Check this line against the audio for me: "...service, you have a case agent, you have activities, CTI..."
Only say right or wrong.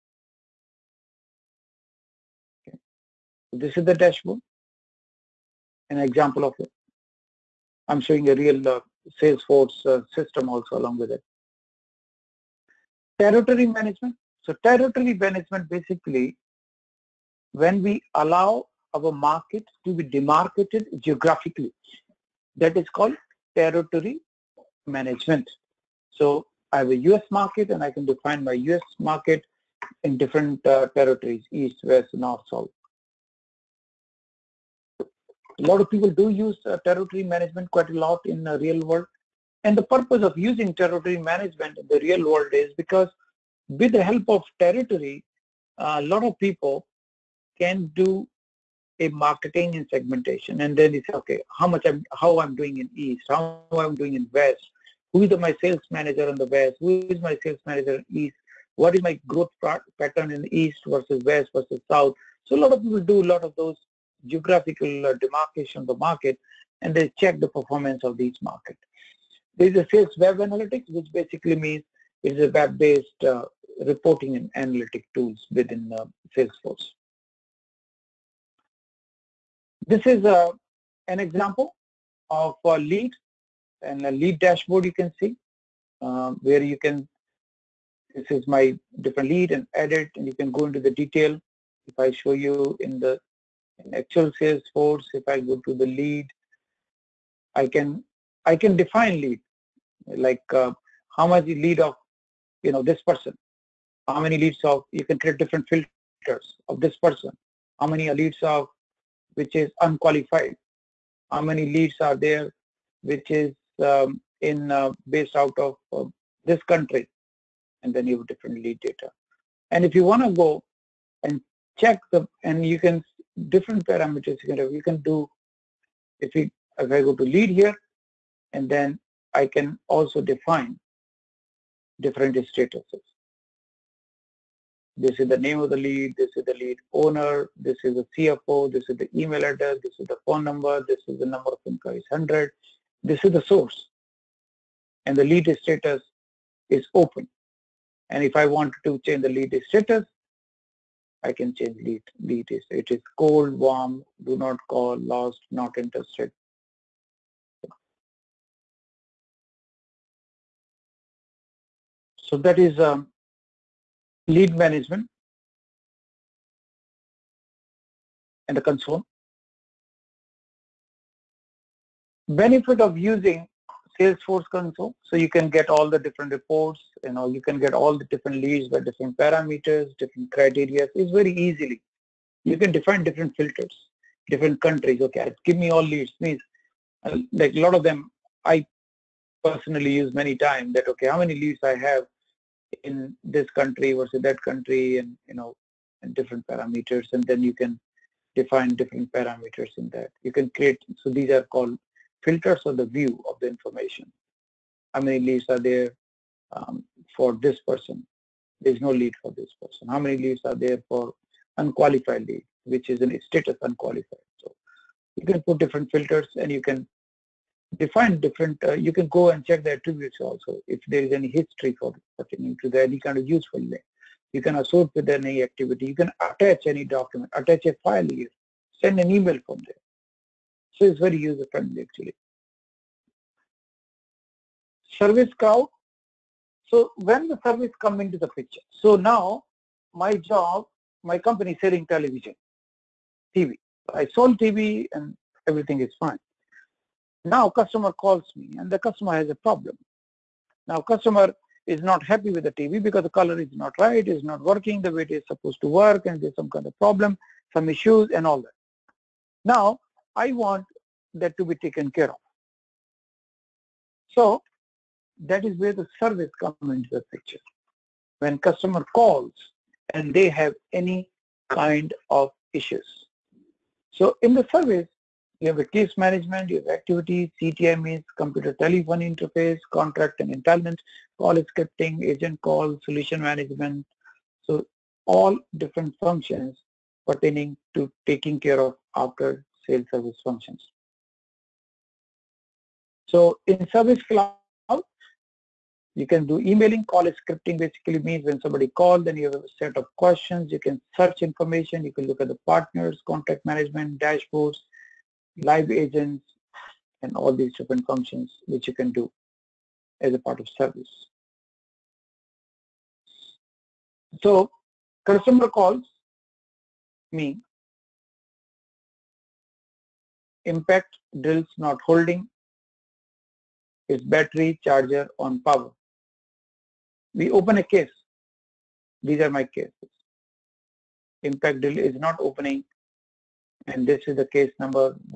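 wrong.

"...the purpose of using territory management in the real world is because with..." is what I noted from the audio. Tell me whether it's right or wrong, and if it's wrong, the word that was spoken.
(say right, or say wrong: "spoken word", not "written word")
right.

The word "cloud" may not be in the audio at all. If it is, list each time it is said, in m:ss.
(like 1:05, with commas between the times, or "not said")
3:55, 4:54.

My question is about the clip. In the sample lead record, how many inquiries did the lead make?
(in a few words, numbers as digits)
100.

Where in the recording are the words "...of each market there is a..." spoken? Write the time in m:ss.
1:08.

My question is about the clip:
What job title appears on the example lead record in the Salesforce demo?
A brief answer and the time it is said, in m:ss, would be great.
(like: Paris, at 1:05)
CFO, at 2:18.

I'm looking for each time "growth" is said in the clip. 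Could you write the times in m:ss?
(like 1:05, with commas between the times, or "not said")
0:59.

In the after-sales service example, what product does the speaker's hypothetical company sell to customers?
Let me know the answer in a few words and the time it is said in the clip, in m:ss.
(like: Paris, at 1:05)
Television, at 4:01.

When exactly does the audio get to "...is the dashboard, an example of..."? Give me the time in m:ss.
0:03.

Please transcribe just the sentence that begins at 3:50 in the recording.
So it's very user friendly actually.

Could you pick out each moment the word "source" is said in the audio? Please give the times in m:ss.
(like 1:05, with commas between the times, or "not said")
2:23.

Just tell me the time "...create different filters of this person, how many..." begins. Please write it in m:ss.
1:45.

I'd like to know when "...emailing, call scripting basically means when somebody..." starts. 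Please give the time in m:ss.
4:56.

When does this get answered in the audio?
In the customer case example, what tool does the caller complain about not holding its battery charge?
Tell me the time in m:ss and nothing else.
5:20.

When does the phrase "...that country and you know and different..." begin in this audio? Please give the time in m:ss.
3:14.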